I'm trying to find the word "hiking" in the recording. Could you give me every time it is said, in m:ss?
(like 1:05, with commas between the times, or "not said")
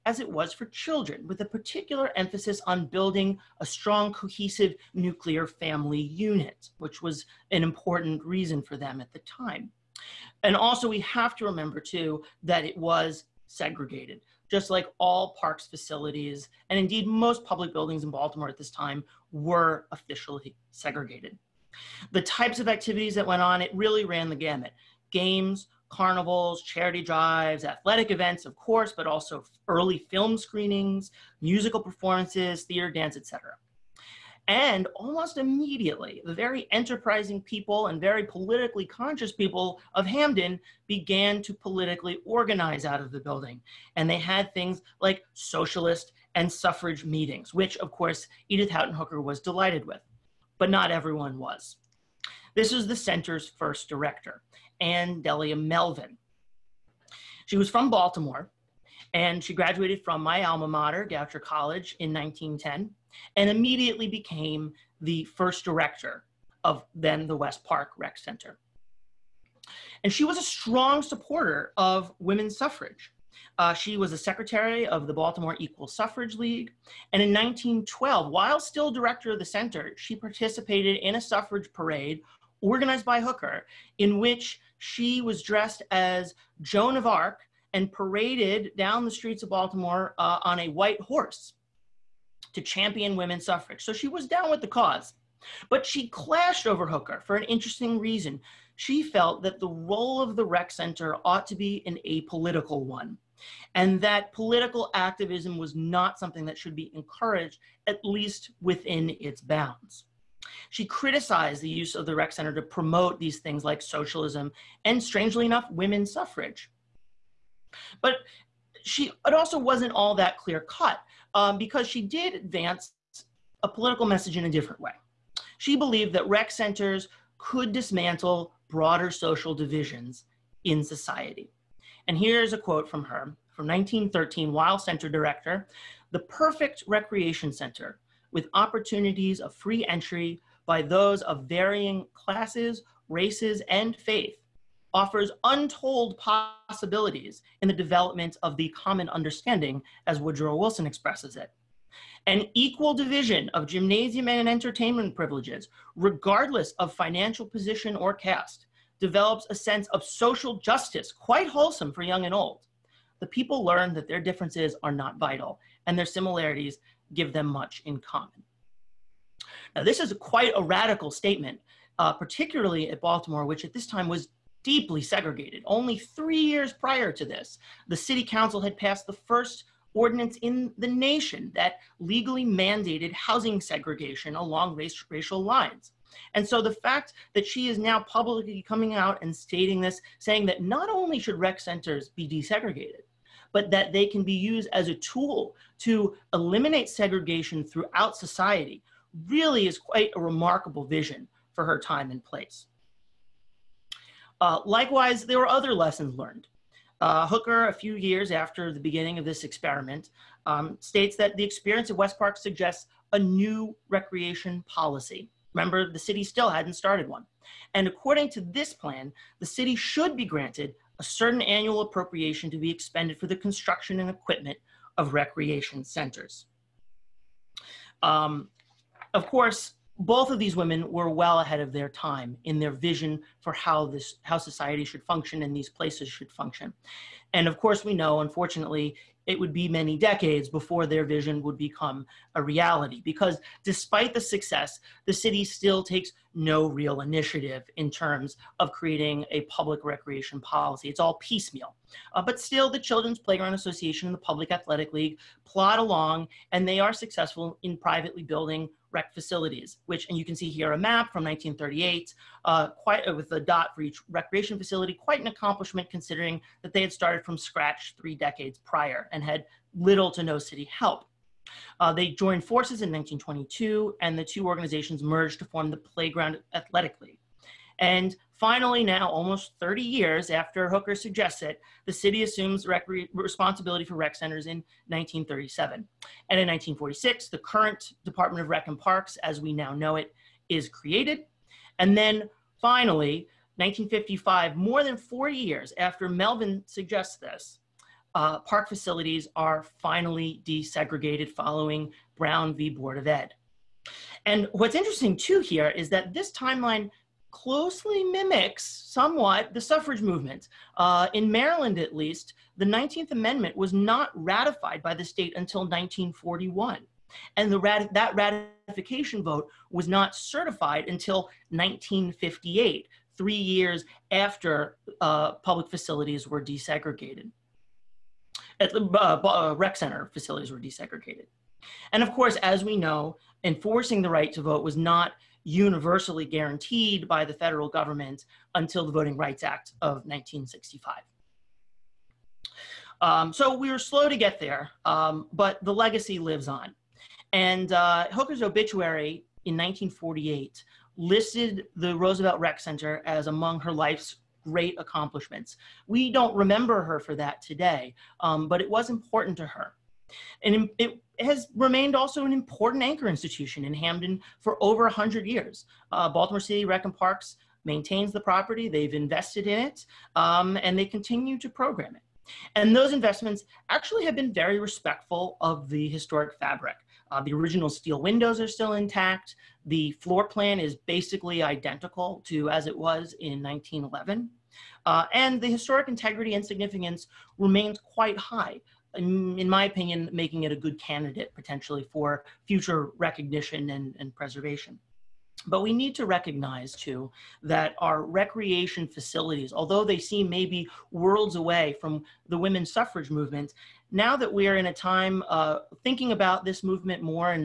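not said.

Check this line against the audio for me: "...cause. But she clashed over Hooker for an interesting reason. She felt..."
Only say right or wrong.
right.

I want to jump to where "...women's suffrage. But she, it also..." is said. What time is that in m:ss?
1:55.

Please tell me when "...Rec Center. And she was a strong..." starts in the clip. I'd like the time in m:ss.
1:07.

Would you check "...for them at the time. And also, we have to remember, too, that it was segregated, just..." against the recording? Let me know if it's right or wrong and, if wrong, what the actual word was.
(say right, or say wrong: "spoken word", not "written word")
right.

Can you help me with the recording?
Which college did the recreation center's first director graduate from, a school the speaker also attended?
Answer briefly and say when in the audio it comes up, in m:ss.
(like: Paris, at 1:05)
Goucher College, at 1:01.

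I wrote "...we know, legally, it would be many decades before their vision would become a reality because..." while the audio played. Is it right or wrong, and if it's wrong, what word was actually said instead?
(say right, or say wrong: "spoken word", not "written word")
wrong: "unfortunately", not "legally".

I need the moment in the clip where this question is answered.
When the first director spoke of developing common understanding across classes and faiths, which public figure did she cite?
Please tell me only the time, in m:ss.
2:30.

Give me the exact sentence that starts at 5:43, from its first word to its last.
Um, so we were slow to get there, um, but the legacy lives on.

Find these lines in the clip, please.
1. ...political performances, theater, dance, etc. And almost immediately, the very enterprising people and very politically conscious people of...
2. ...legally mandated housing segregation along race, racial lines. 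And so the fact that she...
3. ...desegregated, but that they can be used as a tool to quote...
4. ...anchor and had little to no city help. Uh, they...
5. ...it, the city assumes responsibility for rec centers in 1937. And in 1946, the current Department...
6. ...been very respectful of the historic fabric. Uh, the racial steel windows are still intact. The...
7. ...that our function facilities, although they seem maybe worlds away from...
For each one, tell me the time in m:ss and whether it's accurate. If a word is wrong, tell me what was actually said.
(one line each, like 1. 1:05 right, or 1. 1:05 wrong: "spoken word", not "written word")
1. 0:31 wrong: "musical", not "political"
2. 3:01 right
3. 3:12 wrong: "eliminate", not "quote"
4. 4:28 wrong: "prior", not "anchor"
5. 4:41 right
6. 6:14 wrong: "original", not "racial"
7. 6:37 wrong: "recreation", not "function".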